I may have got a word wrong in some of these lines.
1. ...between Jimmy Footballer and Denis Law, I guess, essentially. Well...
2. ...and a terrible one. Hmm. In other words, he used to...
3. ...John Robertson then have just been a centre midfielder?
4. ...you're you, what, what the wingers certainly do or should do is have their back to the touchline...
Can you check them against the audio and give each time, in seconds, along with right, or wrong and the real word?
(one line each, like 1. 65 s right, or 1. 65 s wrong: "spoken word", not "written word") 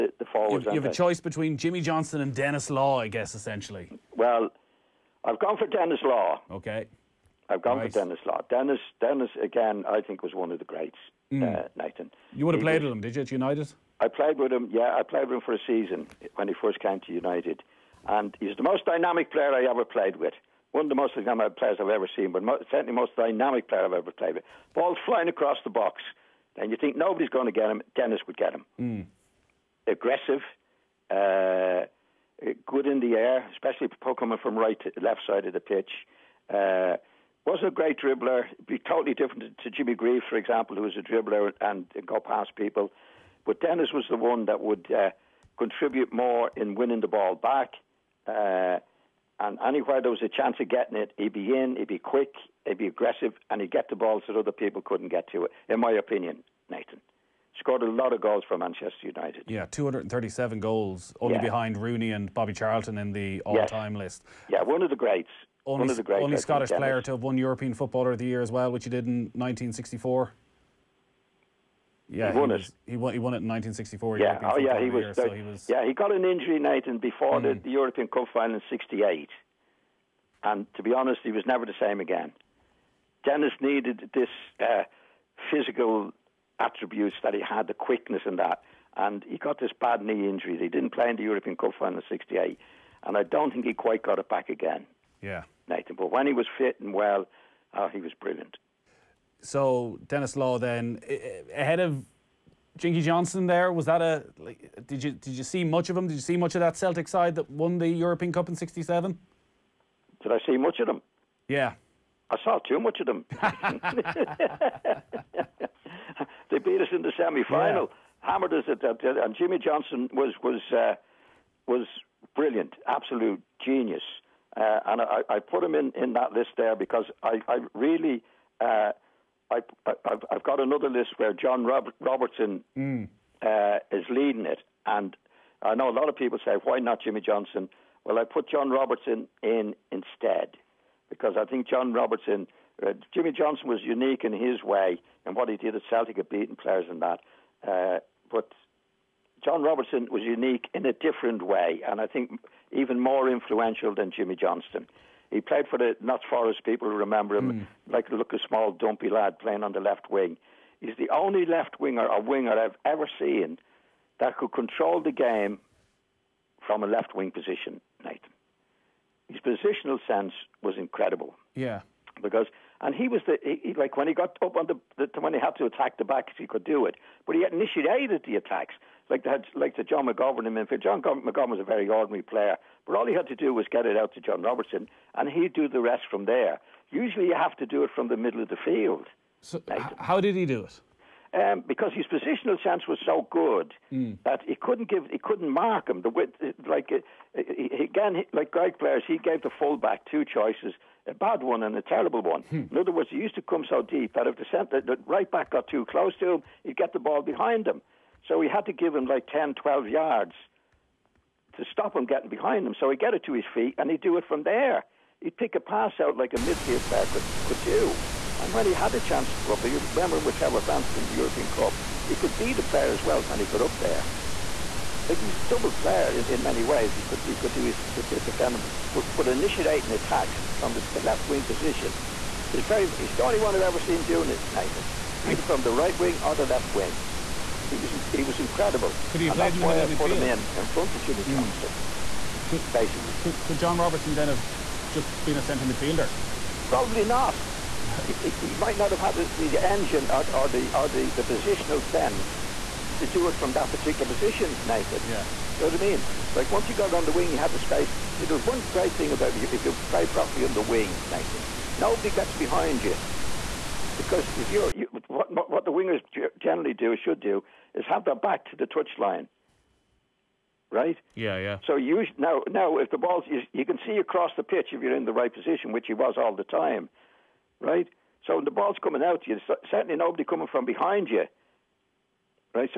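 1. 1 s wrong: "Johnstone", not "Footballer"
2. 201 s right
3. 243 s right
4. 264 s wrong: "generally", not "certainly".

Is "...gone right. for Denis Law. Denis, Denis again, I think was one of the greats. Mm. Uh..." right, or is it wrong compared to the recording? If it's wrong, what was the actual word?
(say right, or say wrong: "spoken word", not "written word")
right.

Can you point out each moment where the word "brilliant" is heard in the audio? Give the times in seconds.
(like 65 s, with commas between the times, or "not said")
98 s, 122 s.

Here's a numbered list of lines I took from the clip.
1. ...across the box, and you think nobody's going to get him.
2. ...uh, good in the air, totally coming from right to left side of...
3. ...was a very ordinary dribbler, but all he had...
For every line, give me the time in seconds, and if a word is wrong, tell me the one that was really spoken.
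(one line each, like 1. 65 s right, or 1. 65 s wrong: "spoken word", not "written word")
1. 25 s right
2. 31 s wrong: "especially", not "totally"
3. 181 s wrong: "player", not "dribbler".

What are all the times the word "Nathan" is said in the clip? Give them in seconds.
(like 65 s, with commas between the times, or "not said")
11 s, 56 s, 76 s, 95 s, 168 s, 234 s, 254 s, 261 s.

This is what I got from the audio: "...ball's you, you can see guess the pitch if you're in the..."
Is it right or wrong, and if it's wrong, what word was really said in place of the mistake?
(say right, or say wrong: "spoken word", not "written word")
wrong: "across", not "guess".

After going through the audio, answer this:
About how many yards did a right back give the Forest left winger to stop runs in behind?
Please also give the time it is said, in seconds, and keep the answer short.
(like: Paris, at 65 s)
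10 to 12 yards, at 209 s.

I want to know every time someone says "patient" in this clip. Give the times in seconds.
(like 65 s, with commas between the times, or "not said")
not said.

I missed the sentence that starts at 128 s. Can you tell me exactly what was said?
Uh, I, have I've got another list where John Robert, Robertson mm.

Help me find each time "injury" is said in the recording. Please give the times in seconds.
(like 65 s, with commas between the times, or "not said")
76 s, 90 s.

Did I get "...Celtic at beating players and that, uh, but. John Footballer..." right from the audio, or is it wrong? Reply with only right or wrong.
wrong.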